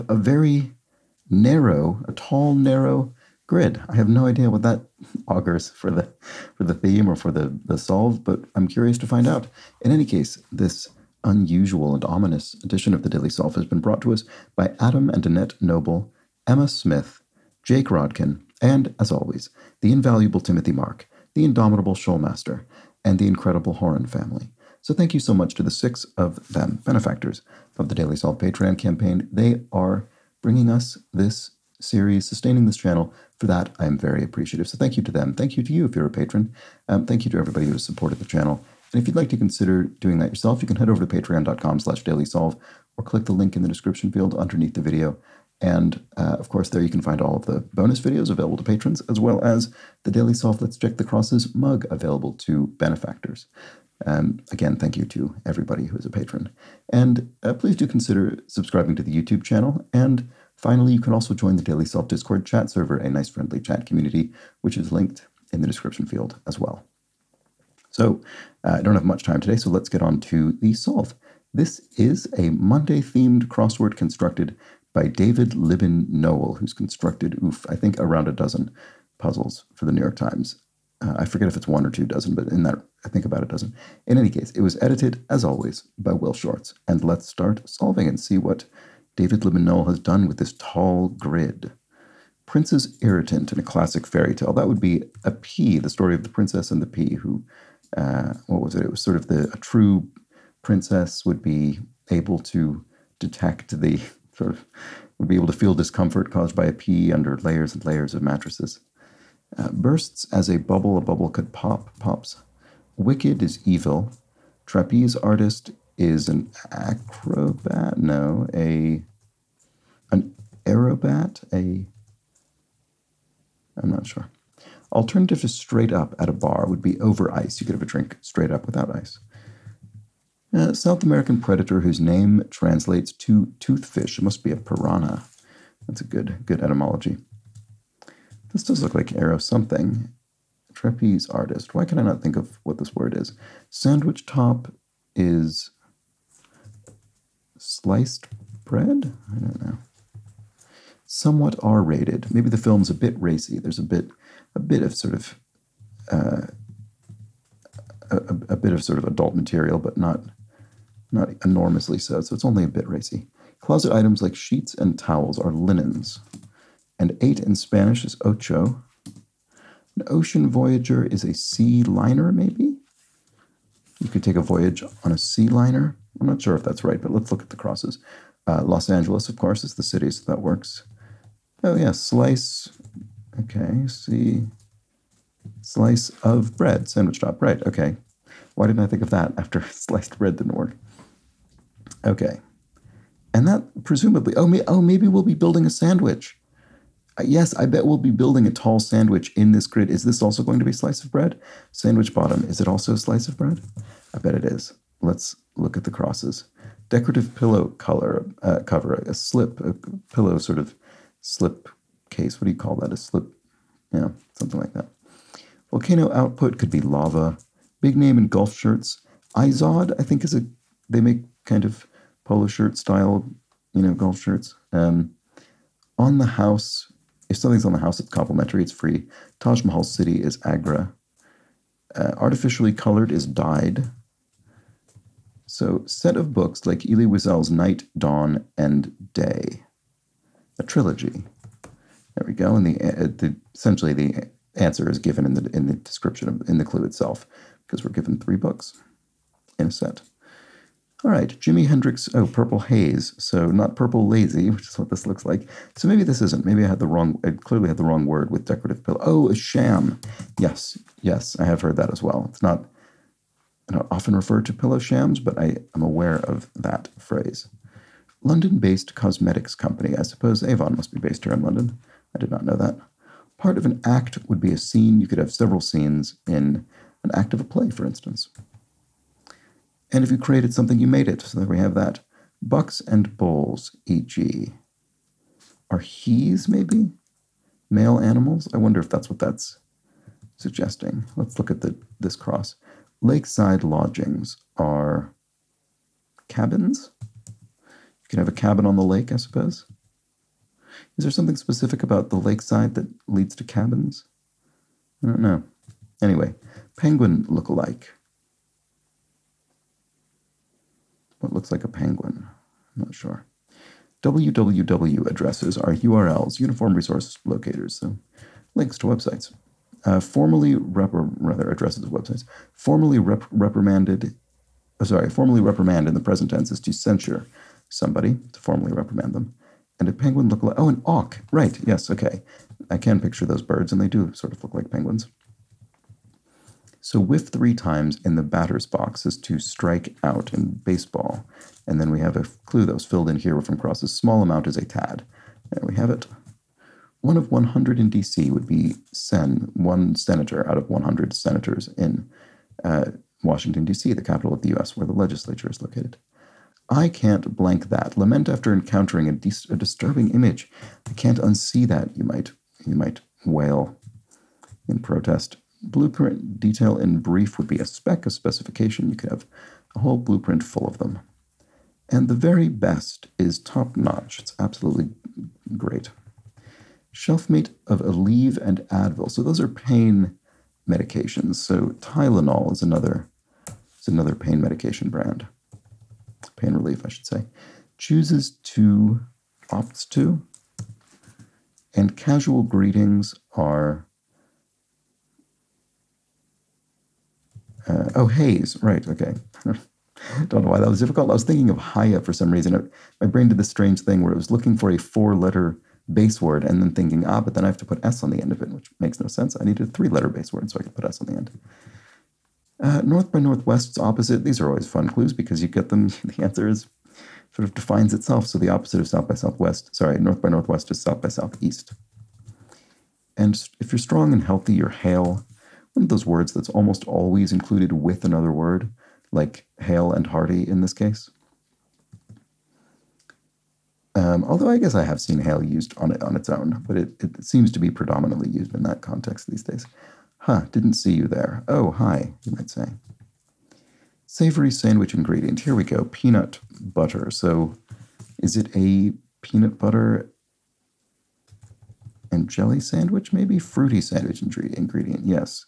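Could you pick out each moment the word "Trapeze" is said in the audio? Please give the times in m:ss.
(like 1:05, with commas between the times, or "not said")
1:54, 2:20.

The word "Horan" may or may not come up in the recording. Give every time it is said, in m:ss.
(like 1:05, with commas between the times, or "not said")
0:23.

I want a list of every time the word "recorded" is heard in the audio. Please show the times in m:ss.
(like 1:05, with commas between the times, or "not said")
not said.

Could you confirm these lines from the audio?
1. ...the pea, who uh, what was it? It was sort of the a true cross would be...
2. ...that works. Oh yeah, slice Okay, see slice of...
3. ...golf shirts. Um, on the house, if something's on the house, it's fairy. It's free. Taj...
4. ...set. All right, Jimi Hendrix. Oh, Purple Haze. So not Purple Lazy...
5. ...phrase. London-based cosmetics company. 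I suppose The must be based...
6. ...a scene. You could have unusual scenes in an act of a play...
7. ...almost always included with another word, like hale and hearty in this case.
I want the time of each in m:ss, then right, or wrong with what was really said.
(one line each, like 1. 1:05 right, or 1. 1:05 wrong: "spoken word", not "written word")
1. 1:36 wrong: "princess", not "cross"
2. 3:00 right
3. 3:43 wrong: "complimentary", not "fairy"
4. 4:09 right
5. 4:26 wrong: "Avon", not "The"
6. 4:34 wrong: "several", not "unusual"
7. 7:06 right.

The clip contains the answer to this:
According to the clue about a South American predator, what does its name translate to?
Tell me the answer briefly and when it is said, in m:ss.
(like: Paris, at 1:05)
toothfish, at 2:13.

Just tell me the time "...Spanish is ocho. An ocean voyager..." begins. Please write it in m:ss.
2:47.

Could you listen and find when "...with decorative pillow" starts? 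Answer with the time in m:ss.
4:18.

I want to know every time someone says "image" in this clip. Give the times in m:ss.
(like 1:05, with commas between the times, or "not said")
6:00.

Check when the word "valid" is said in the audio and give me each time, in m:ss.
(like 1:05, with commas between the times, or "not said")
not said.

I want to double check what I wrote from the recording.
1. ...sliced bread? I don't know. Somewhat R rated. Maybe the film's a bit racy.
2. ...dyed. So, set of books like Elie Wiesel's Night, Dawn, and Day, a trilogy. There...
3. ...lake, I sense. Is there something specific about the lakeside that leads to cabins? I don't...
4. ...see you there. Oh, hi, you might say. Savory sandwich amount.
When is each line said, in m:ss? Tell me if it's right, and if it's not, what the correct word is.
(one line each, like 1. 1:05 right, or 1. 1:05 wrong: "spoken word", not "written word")
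1. 2:27 right
2. 3:53 right
3. 4:58 wrong: "suppose", not "sense"
4. 7:20 wrong: "ingredient", not "amount".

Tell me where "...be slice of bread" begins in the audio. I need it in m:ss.
3:20.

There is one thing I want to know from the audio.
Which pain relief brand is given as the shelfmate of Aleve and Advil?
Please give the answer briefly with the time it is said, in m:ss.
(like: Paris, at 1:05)
Tylenol, at 6:21.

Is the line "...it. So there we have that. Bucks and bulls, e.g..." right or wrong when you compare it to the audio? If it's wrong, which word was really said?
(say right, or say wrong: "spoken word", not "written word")
right.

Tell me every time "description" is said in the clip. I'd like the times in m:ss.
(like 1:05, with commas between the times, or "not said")
0:43, 1:05, 4:05.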